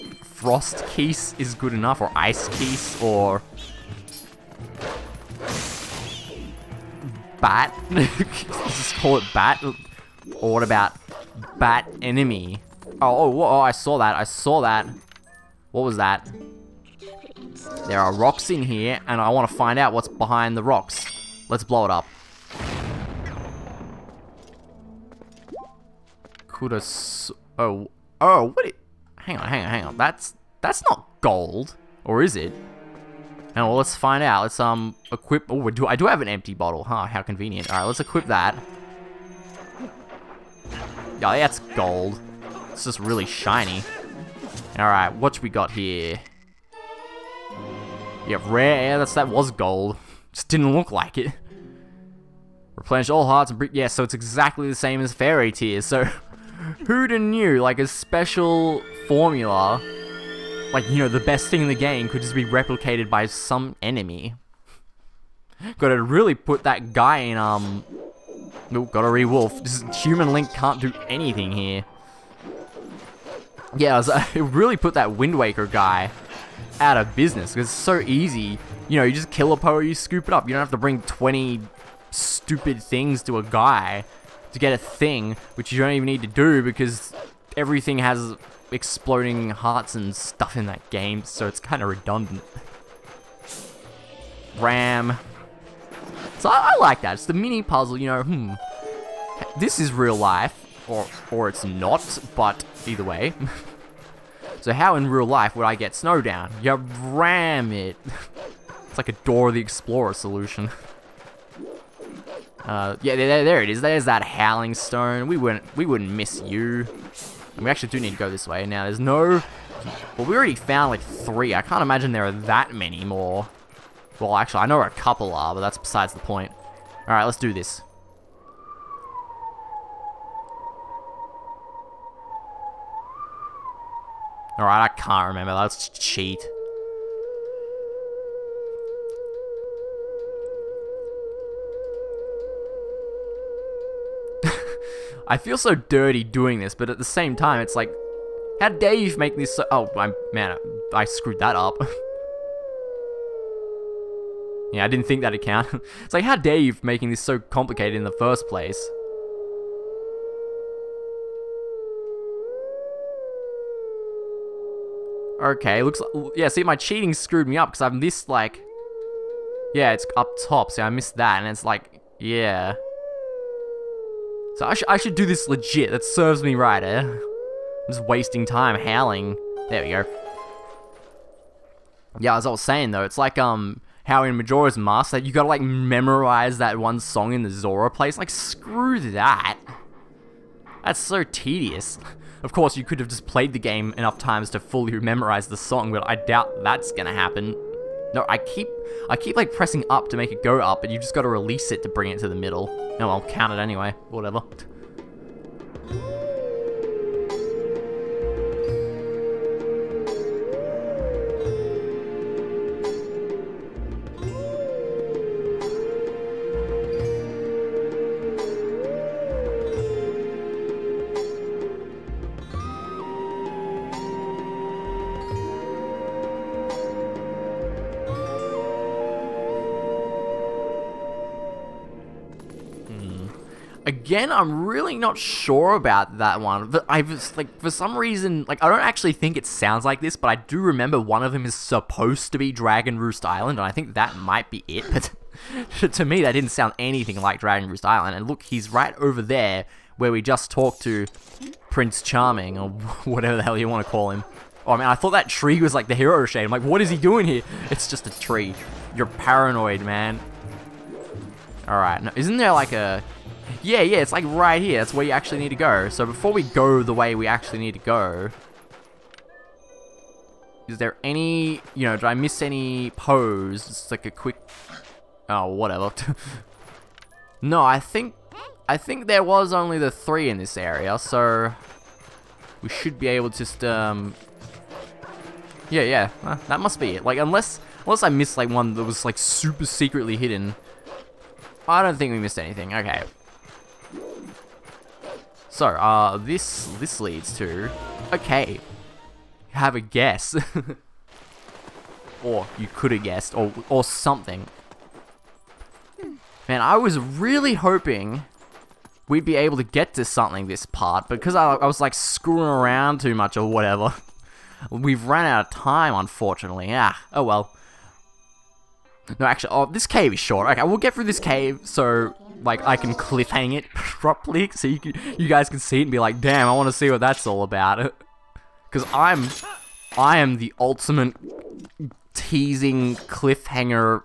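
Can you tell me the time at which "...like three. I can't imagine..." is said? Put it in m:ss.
2:00.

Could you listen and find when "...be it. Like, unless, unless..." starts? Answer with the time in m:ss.
4:46.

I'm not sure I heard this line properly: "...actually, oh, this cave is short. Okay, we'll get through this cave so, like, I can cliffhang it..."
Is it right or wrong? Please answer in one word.
right.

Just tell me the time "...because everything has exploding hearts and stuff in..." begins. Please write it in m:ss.
1:26.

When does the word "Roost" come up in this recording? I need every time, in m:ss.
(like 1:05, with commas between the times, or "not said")
4:02, 4:07.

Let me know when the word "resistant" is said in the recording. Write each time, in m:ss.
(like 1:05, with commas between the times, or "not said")
not said.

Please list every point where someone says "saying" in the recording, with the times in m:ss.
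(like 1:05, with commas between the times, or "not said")
3:02.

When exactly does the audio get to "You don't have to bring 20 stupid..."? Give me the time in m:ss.
1:20.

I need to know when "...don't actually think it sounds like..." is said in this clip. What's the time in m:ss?
3:58.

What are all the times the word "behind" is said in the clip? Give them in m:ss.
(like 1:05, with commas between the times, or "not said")
0:20.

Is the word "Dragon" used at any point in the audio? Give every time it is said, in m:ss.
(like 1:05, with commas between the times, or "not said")
4:02, 4:07.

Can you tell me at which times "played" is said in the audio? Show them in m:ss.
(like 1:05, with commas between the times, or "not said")
3:13.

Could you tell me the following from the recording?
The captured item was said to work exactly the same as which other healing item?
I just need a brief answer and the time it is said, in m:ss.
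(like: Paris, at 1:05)
Fairy tears, at 0:55.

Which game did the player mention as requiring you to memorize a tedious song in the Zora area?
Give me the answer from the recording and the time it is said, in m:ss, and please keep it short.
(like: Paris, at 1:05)
Majora's Mask, at 3:04.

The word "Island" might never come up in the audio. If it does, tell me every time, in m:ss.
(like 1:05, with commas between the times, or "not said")
4:03, 4:07.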